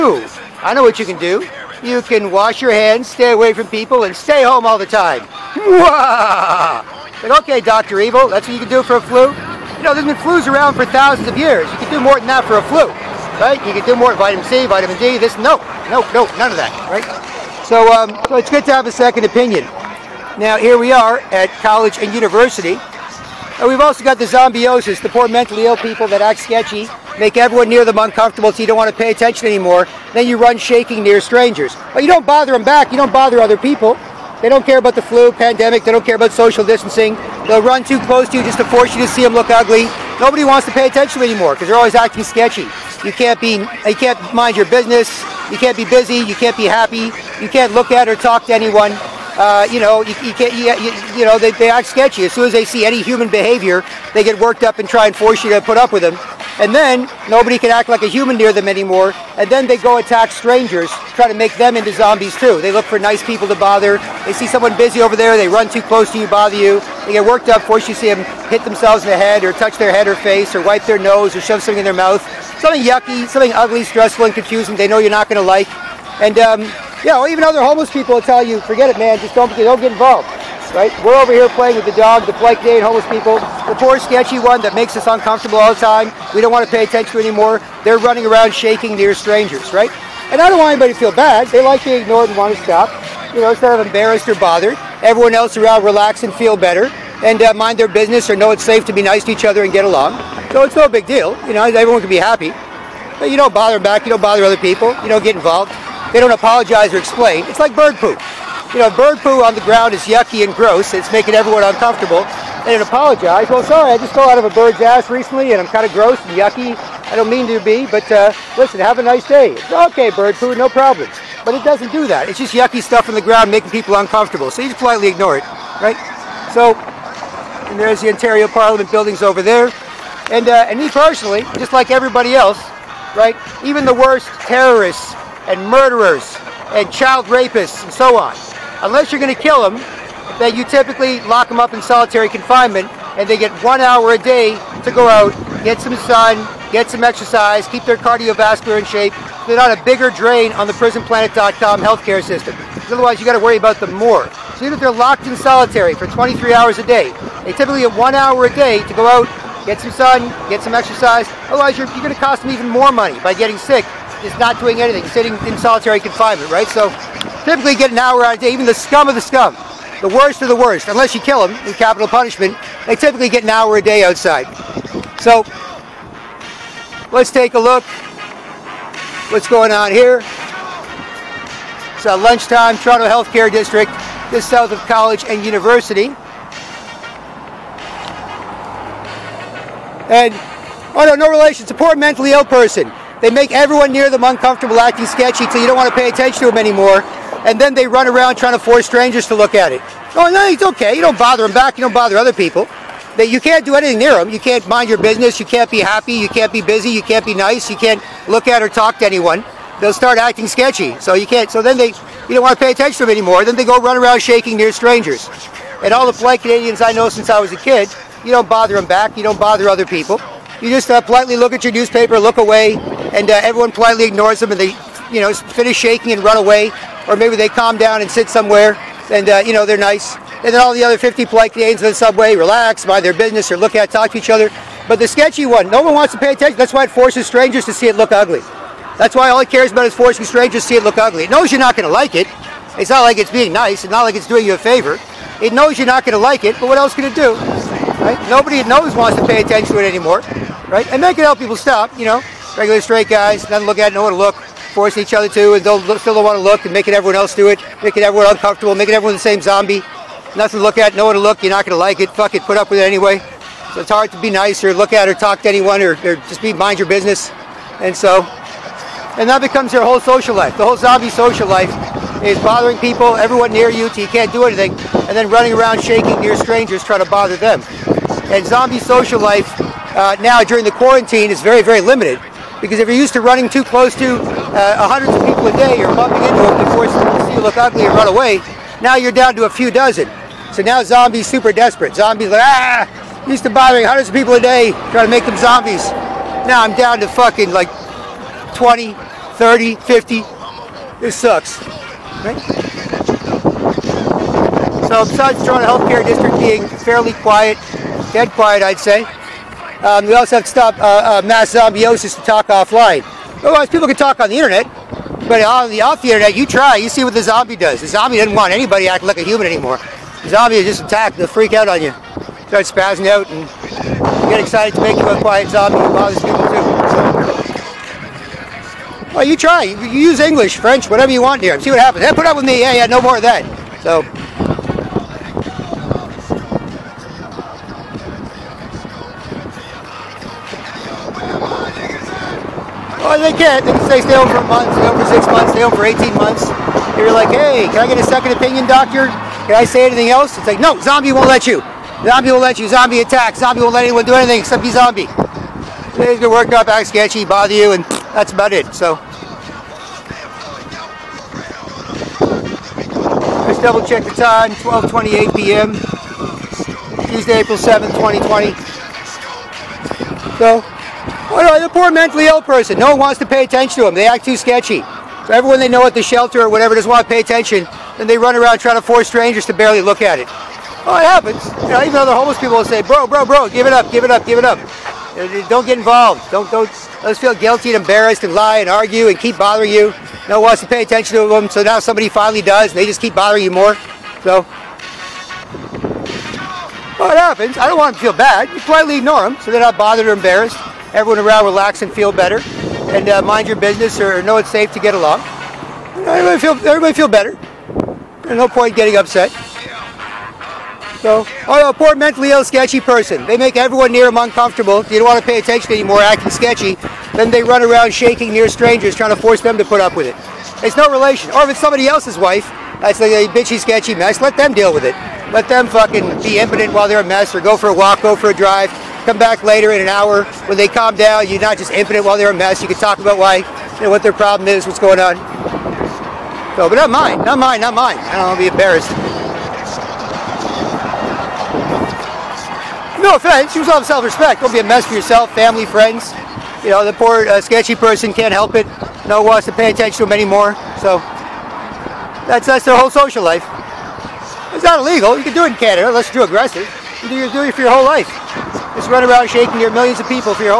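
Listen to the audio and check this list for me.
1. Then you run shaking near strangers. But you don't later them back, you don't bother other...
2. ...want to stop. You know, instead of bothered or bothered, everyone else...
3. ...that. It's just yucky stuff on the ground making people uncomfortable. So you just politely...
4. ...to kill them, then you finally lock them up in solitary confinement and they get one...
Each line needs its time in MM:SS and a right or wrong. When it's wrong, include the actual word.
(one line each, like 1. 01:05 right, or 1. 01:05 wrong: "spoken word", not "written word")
1. 00:30 wrong: "bother", not "later"
2. 01:32 wrong: "embarrassed", not "bothered"
3. 02:02 right
4. 02:19 wrong: "typically", not "finally".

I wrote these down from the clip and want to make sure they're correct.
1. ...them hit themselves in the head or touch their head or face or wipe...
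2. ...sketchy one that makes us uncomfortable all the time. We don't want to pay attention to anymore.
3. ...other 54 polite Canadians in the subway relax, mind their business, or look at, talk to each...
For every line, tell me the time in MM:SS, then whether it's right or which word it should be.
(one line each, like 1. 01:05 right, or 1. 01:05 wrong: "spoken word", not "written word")
1. 01:08 right
2. 01:23 right
3. 03:50 wrong: "50", not "54".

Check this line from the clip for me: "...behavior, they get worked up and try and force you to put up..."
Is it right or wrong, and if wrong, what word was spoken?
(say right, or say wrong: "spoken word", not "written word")
right.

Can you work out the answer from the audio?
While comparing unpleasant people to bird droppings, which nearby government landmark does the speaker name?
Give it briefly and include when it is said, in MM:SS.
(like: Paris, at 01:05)
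Ontario Parliament buildings, at 02:08.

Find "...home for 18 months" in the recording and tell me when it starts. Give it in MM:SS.
05:45.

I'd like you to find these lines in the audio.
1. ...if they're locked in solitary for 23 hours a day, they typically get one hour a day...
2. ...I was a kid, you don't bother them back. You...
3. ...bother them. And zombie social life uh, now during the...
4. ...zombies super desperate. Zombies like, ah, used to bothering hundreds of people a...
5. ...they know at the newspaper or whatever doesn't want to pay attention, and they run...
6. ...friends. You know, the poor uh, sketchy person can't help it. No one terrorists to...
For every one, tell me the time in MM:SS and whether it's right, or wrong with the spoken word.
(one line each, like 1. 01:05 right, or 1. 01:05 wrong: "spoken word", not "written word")
1. 02:34 right
2. 03:37 right
3. 04:37 right
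4. 04:50 right
5. 06:15 wrong: "shelter", not "newspaper"
6. 07:25 wrong: "wants", not "terrorists".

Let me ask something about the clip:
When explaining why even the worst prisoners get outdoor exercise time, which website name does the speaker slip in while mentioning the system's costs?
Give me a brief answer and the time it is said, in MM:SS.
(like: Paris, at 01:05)
prisonplanet.com, at 02:30.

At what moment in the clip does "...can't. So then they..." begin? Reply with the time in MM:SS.
03:31.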